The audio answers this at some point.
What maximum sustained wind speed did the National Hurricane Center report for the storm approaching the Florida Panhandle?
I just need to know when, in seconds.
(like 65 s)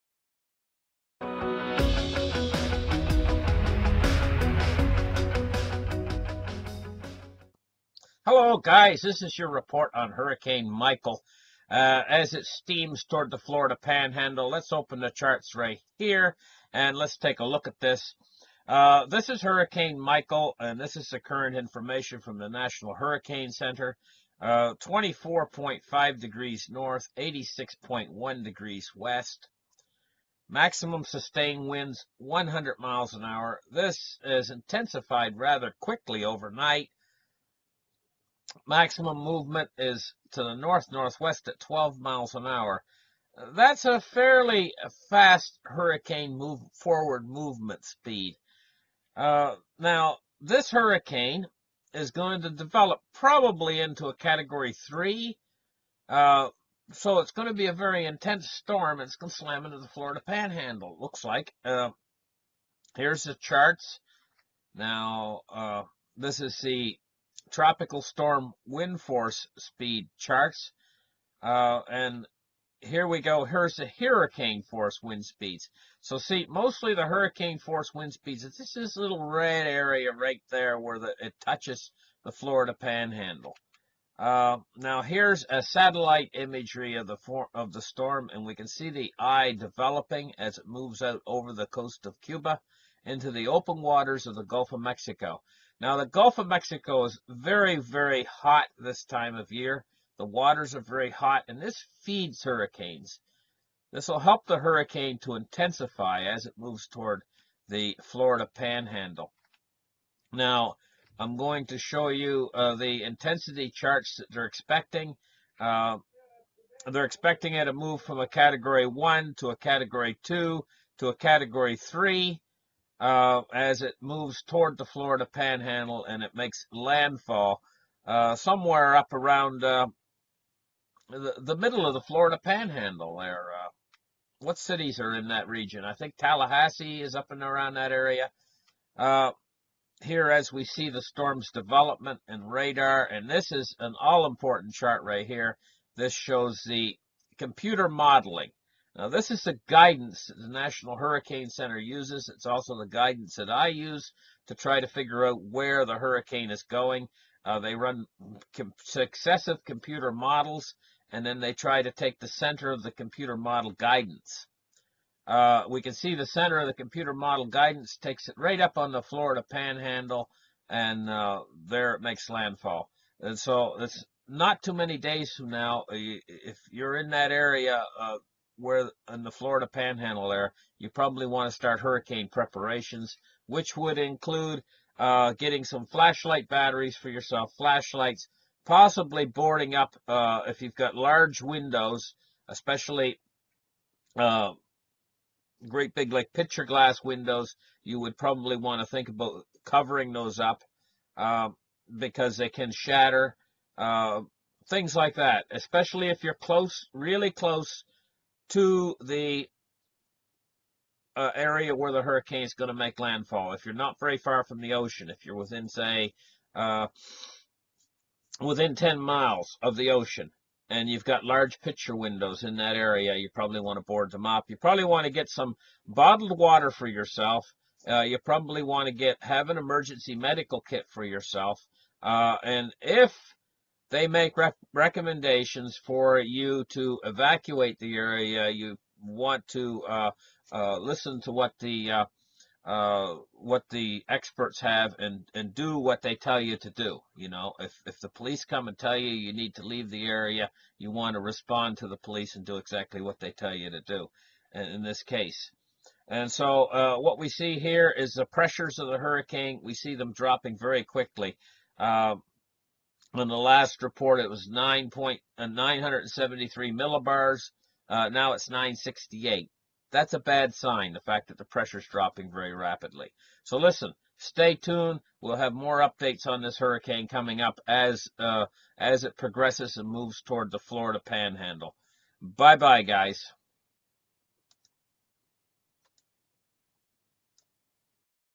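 32 s.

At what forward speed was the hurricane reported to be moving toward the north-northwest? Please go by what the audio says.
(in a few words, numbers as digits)
12 miles an hour.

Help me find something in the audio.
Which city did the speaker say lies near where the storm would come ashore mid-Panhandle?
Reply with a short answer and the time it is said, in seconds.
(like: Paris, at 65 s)
Tallahassee, at 136 s.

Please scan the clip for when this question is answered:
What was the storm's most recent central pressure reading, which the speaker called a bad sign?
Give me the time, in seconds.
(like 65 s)
268 s.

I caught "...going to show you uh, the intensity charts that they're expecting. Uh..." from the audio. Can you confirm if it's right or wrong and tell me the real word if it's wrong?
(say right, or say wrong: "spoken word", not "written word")
right.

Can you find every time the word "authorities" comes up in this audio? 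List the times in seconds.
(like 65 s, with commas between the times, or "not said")
not said.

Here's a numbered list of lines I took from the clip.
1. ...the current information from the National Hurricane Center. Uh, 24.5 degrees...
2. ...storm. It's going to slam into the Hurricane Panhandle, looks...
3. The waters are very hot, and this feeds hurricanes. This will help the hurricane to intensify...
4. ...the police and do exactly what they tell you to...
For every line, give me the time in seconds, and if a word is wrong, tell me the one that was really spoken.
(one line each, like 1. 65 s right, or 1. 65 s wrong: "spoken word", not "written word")
1. 21 s right
2. 58 s wrong: "Florida", not "Hurricane"
3. 100 s right
4. 251 s right.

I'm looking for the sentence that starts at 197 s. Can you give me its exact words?
You would probably want to think about covering those up um, because they can shatter.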